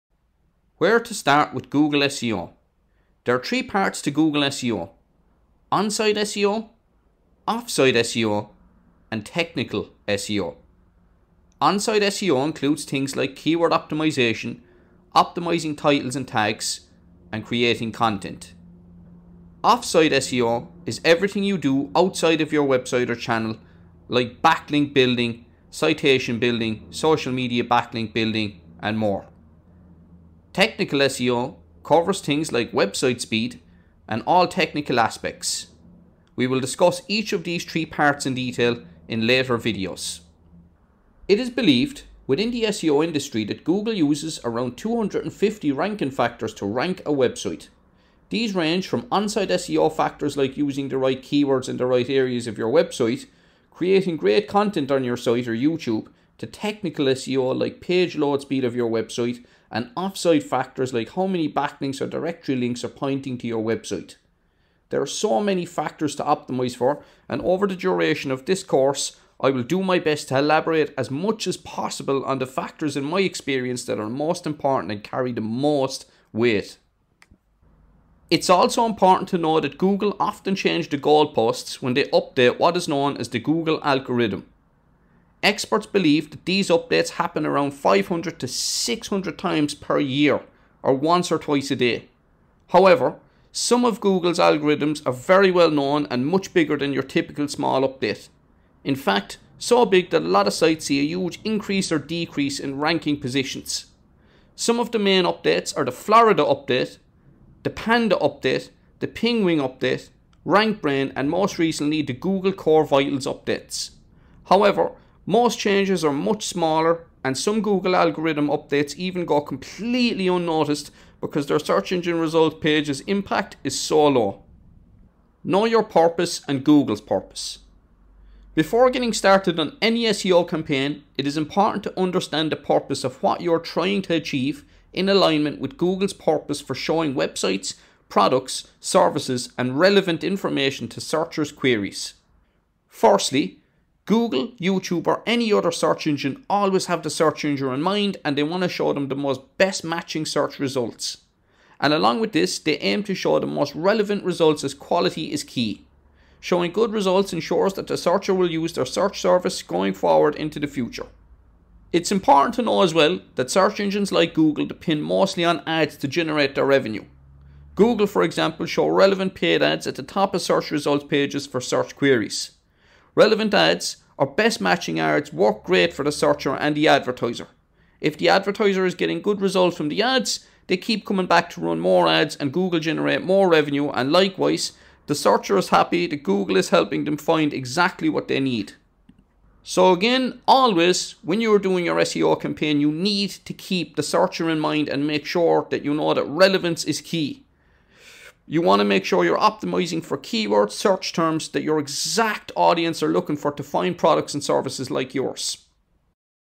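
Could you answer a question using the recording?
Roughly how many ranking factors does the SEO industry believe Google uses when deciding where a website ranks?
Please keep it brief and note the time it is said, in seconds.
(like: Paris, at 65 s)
250, at 44 s.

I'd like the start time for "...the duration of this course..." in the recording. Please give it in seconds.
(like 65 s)
67 s.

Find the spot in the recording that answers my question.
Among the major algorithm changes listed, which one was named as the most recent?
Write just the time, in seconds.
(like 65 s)
112 s.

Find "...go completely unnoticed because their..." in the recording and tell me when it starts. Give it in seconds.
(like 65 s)
119 s.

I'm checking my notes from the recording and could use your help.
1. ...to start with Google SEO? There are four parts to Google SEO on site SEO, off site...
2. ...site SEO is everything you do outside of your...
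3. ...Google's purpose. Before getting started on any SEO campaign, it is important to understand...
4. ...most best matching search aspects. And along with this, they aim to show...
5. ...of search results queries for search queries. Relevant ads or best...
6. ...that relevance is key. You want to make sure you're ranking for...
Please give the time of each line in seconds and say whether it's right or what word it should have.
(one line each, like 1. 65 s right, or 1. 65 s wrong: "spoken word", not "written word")
1. 0 s wrong: "three", not "four"
2. 19 s right
3. 126 s right
4. 149 s wrong: "results", not "aspects"
5. 170 s wrong: "pages", not "queries"
6. 196 s wrong: "optimizing", not "ranking".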